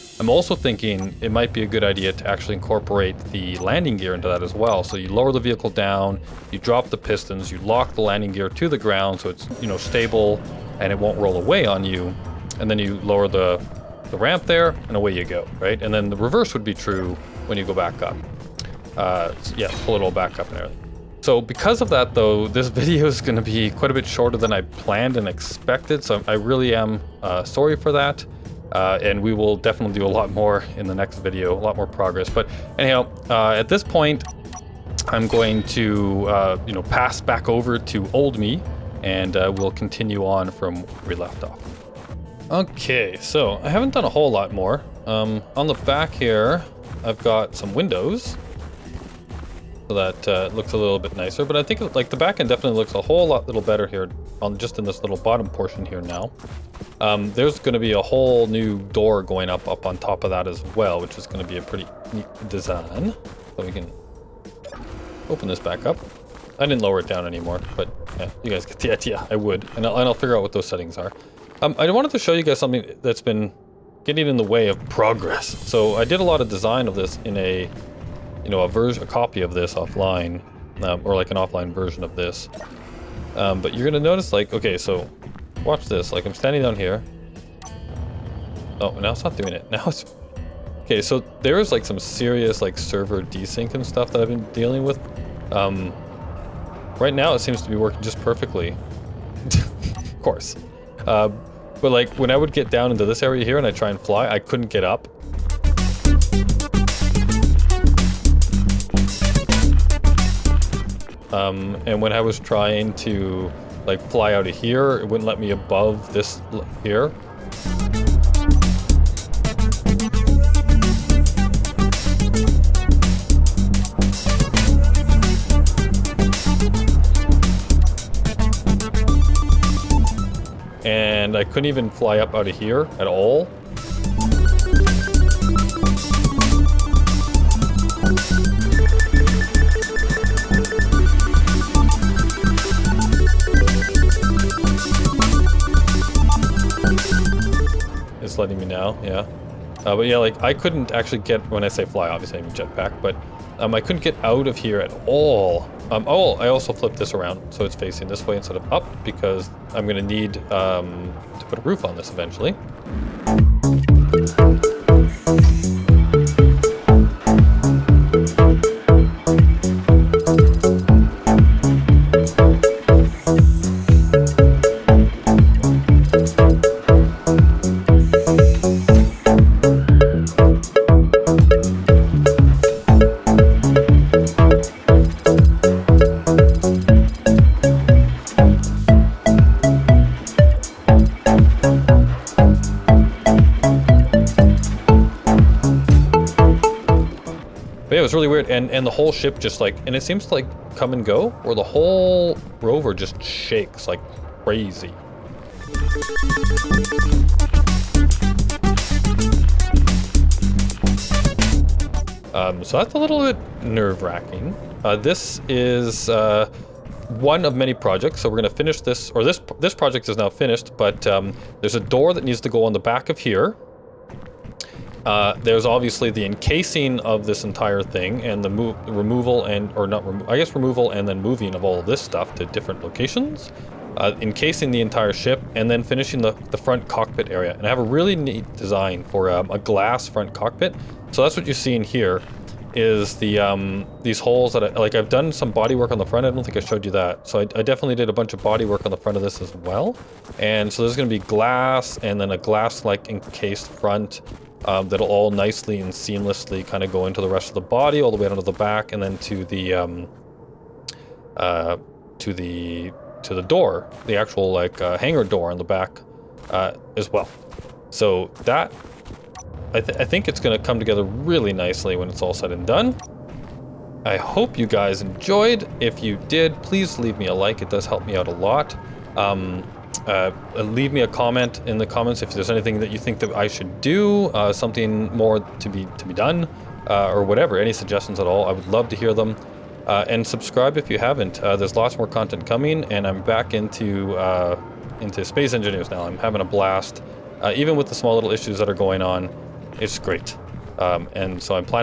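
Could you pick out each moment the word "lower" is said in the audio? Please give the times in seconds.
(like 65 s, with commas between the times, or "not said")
5 s, 13 s, 66 s.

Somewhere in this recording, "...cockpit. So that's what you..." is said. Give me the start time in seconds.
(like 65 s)
240 s.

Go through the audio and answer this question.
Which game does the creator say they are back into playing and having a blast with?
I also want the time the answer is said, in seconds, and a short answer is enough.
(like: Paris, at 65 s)
Space Engineers, at 295 s.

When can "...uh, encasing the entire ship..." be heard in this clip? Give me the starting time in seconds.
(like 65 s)
233 s.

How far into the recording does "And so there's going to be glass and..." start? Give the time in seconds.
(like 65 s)
250 s.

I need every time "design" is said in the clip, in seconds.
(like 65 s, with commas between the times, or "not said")
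62 s, 76 s, 238 s.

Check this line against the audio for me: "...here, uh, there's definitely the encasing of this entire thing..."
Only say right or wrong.
wrong.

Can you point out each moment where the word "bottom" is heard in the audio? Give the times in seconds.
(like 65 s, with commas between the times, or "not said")
55 s.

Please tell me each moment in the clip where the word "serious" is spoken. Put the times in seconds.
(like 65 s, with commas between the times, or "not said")
91 s.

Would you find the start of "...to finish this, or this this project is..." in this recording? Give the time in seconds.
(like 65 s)
218 s.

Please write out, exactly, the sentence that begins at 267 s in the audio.
So that I, th I think it's going to come together really nicely when it's all said and done.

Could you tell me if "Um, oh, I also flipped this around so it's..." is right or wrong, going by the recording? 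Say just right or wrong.
right.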